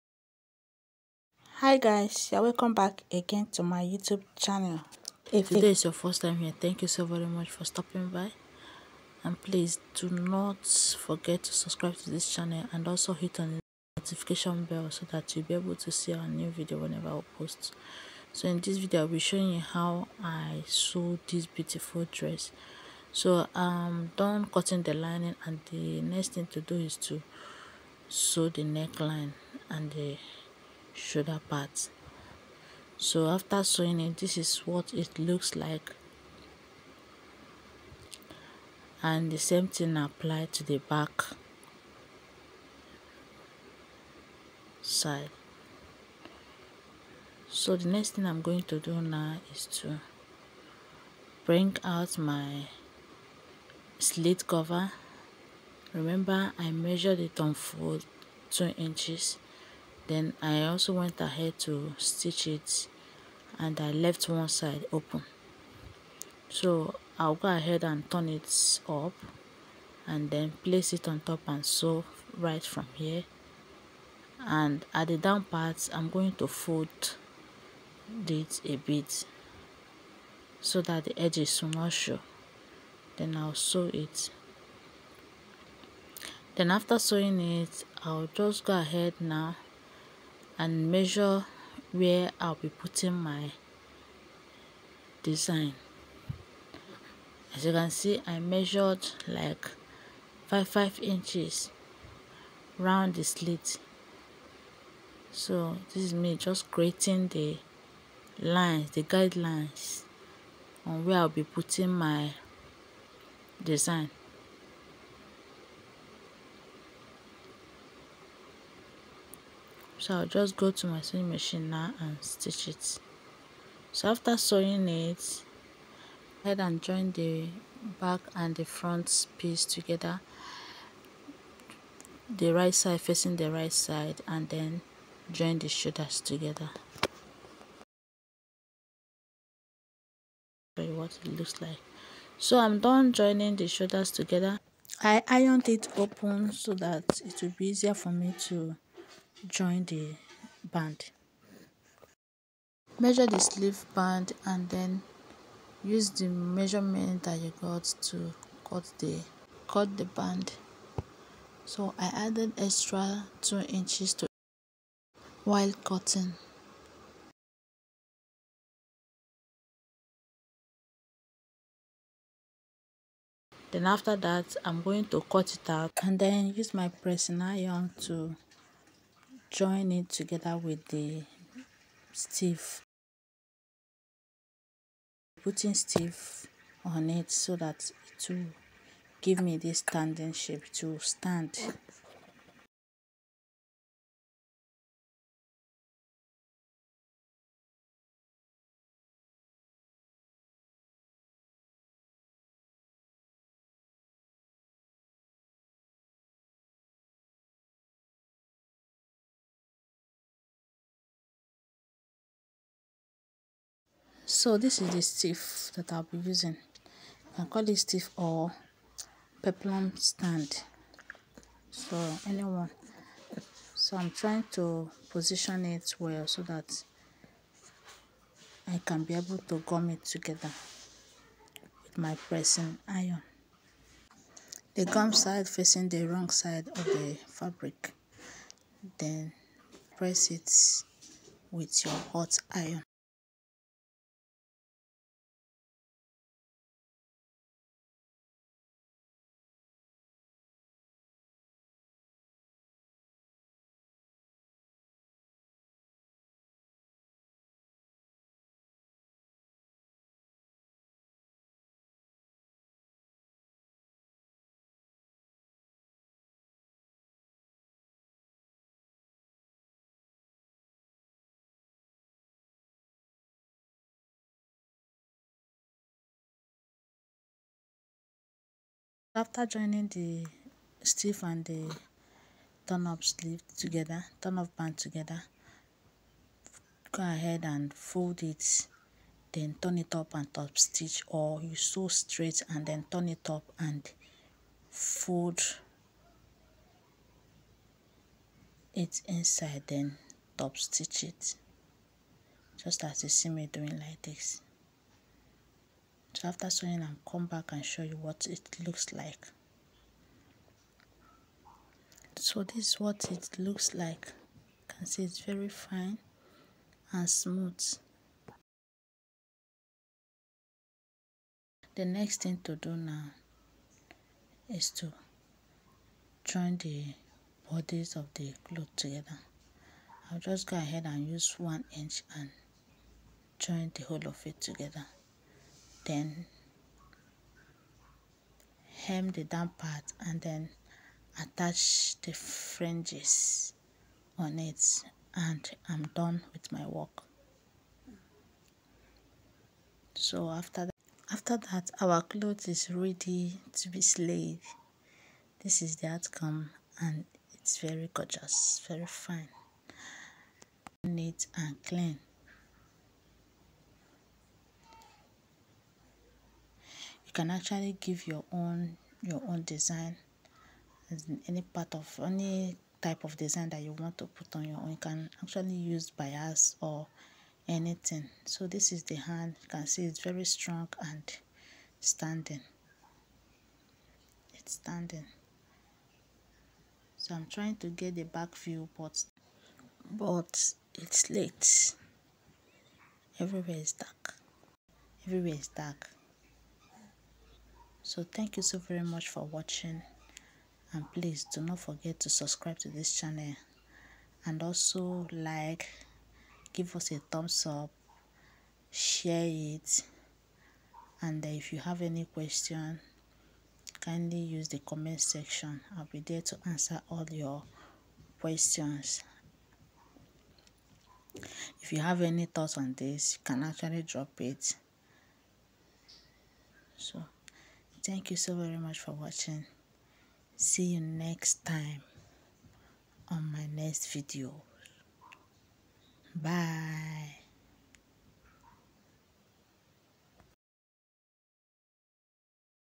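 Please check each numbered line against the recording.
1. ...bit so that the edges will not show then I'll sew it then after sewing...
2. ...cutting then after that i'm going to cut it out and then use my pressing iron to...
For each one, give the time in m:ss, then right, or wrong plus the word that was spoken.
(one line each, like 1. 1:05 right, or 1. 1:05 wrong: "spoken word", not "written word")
1. 1:18 right
2. 2:45 right.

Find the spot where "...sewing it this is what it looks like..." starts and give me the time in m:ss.
0:33.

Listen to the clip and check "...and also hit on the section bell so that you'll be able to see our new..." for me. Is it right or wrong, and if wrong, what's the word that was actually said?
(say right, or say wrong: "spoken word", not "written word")
wrong: "notification", not "section".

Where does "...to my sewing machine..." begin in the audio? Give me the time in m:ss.
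2:00.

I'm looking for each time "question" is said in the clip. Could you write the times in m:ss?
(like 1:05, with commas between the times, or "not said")
6:52, 6:58.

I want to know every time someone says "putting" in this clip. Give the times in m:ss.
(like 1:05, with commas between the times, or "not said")
1:32, 1:51, 3:05.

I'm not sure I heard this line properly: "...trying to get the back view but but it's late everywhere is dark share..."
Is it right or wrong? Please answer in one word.
wrong.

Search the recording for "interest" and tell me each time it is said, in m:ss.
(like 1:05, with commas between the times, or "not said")
not said.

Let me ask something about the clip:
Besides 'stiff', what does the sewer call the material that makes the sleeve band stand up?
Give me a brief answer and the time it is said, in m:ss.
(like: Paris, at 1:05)
peplum stand, at 3:39.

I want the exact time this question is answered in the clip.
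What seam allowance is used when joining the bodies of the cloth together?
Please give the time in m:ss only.
5:31.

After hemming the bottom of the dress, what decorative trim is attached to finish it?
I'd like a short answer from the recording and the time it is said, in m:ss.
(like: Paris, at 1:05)
fringes, at 5:42.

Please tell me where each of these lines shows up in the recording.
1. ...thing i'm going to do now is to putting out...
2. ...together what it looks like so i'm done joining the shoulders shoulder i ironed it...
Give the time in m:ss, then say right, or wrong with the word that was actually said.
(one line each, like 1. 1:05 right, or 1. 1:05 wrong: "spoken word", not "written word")
1. 0:48 wrong: "bring", not "putting"
2. 2:16 wrong: "together", not "shoulder".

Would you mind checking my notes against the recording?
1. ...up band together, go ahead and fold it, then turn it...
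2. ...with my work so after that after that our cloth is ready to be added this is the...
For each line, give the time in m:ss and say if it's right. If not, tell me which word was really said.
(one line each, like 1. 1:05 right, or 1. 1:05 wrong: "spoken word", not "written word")
1. 4:44 right
2. 5:46 wrong: "slayed", not "added".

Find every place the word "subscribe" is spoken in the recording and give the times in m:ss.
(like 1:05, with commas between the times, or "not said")
0:11, 6:42.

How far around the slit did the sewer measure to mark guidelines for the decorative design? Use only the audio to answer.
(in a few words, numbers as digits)
5 inches.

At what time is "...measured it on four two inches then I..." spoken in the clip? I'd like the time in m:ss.
0:56.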